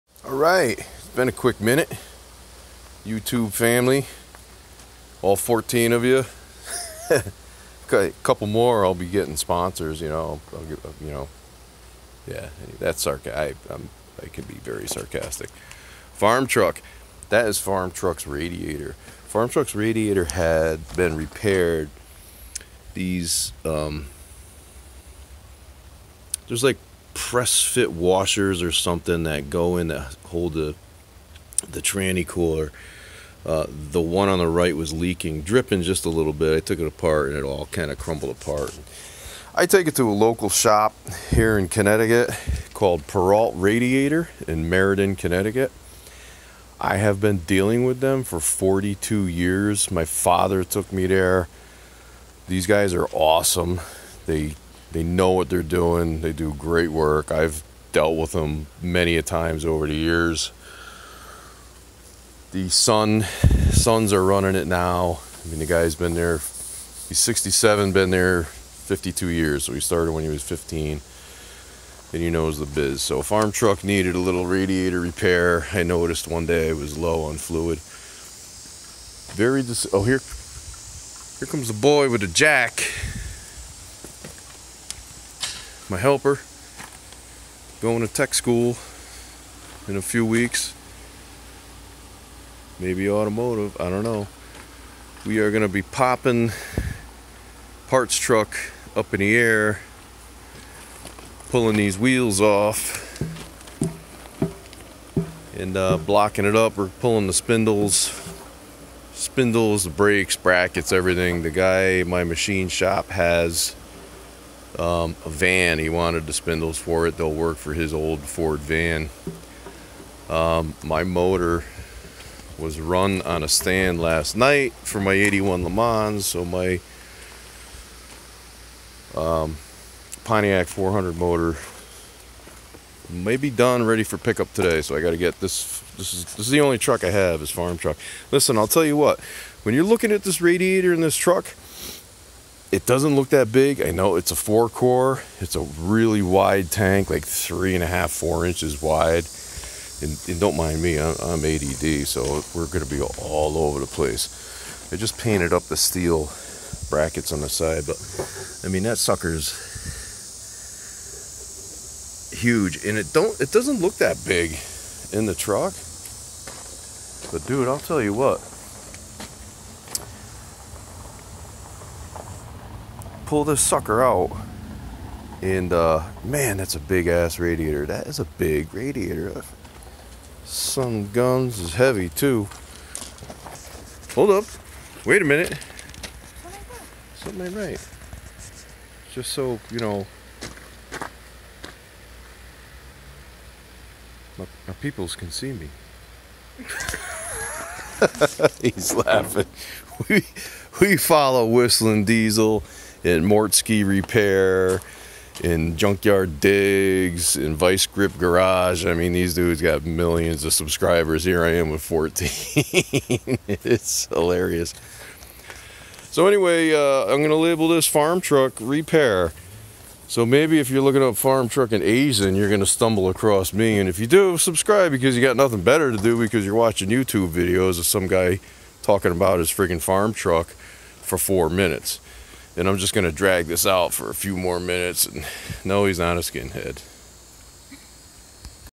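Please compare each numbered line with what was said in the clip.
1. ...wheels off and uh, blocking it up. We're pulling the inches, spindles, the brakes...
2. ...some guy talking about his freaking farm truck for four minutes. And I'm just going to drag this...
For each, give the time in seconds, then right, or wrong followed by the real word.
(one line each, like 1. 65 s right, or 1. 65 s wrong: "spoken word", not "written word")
1. 101 s wrong: "spindles", not "inches"
2. 227 s right.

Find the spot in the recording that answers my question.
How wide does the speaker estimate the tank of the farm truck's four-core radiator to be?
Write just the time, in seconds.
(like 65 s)
147 s.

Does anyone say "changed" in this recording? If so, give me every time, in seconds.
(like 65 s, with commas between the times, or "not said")
not said.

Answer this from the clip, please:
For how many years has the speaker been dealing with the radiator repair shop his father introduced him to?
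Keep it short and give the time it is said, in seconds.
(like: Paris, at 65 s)
42, at 48 s.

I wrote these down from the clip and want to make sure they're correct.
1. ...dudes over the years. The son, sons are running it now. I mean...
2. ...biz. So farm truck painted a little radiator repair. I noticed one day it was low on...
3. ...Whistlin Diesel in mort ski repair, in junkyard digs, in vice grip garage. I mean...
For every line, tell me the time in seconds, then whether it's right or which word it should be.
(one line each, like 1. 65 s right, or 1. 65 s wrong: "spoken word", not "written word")
1. 59 s wrong: "times", not "dudes"
2. 72 s wrong: "needed", not "painted"
3. 201 s right.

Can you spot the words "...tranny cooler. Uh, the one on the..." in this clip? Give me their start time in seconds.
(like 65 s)
31 s.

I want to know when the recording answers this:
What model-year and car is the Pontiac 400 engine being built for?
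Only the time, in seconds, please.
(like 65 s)
125 s.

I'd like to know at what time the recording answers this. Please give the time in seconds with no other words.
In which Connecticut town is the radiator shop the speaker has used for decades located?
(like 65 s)
44 s.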